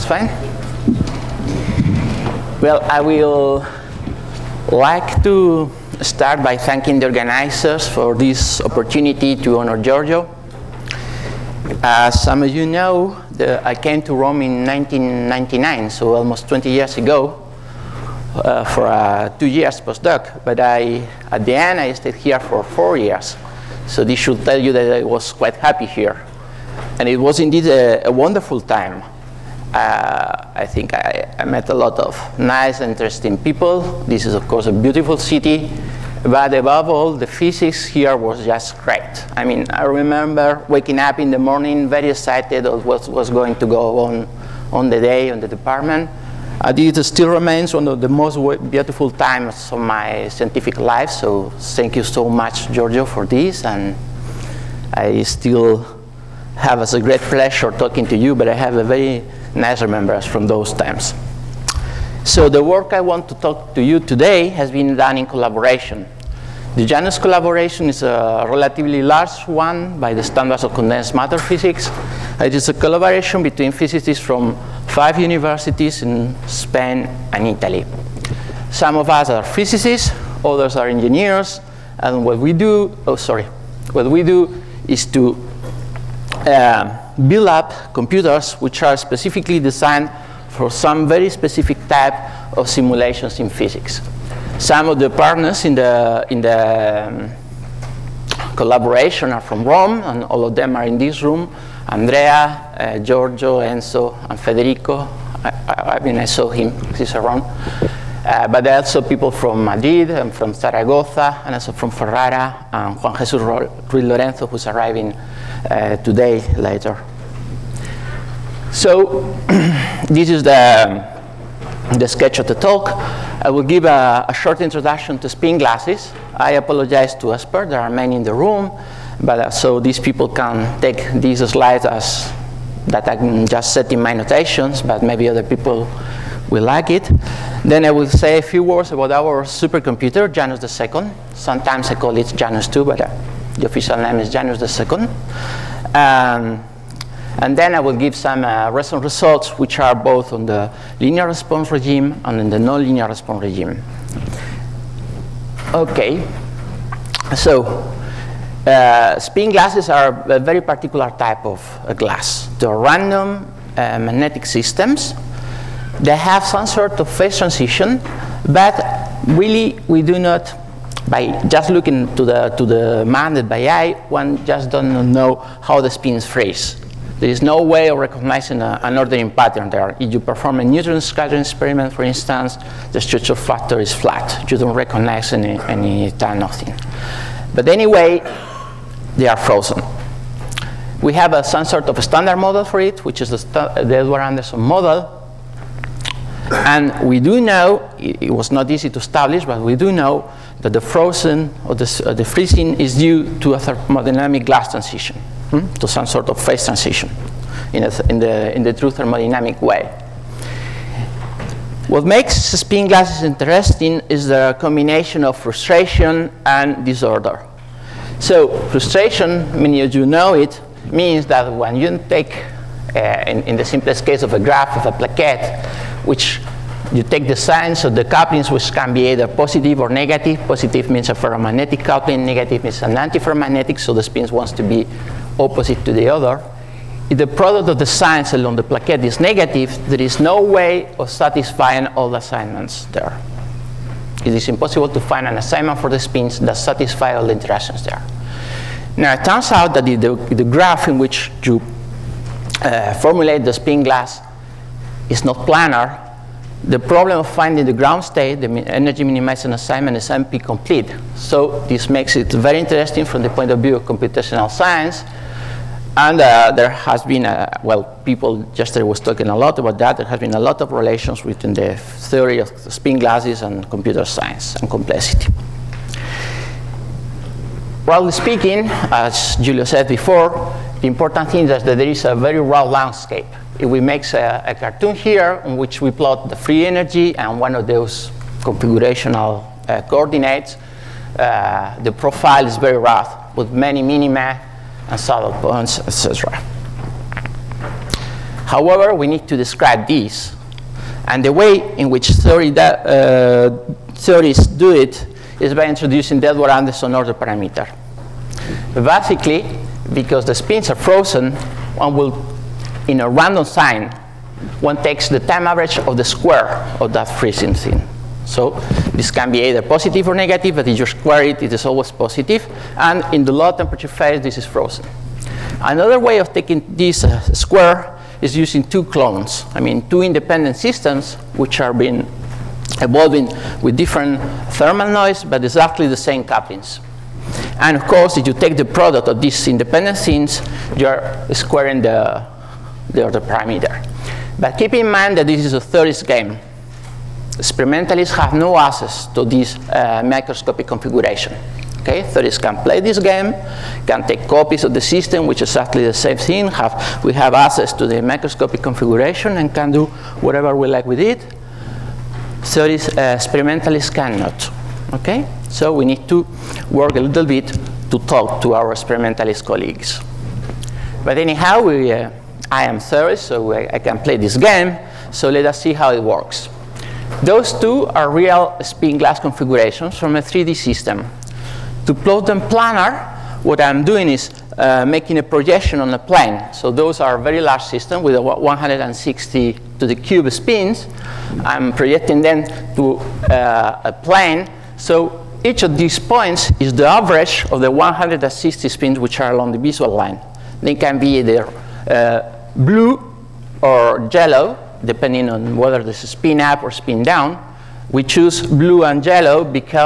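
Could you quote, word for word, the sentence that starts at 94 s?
Some of the partners in the, in the um, collaboration are from Rome, and all of them are in this room.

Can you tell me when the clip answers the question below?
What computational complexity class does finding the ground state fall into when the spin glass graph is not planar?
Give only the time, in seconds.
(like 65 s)
260 s.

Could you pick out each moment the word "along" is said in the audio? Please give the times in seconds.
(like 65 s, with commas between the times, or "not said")
238 s, 399 s.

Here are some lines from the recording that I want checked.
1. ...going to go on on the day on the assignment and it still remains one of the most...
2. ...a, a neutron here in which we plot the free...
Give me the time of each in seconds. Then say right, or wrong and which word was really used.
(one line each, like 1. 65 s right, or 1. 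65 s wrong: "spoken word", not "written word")
1. 43 s wrong: "department", not "assignment"
2. 284 s wrong: "cartoon", not "neutron".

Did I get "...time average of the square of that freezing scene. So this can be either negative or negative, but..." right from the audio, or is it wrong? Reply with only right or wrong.
wrong.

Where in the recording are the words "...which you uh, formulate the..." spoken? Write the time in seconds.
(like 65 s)
250 s.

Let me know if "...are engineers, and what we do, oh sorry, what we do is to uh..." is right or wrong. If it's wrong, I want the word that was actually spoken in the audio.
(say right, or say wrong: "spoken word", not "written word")
right.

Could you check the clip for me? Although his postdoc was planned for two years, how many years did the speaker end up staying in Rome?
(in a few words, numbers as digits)
4.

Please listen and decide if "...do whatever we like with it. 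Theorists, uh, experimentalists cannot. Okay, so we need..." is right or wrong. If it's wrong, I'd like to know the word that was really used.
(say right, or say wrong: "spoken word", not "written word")
right.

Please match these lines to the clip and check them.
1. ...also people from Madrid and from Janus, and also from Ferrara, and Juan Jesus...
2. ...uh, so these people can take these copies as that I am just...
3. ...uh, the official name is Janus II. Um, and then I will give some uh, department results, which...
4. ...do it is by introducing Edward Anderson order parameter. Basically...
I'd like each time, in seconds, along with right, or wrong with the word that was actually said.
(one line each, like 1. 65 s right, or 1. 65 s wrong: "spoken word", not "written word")
1. 108 s wrong: "Zaragoza", not "Janus"
2. 129 s wrong: "slides", not "copies"
3. 143 s wrong: "recent", not "department"
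4. 304 s right.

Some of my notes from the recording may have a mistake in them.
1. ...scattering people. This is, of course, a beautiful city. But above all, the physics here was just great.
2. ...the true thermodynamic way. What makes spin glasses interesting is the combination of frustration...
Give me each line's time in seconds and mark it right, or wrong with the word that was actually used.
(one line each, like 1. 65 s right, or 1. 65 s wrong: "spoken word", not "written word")
1. 32 s wrong: "interesting", not "scattering"
2. 208 s right.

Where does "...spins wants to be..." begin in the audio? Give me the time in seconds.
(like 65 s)
234 s.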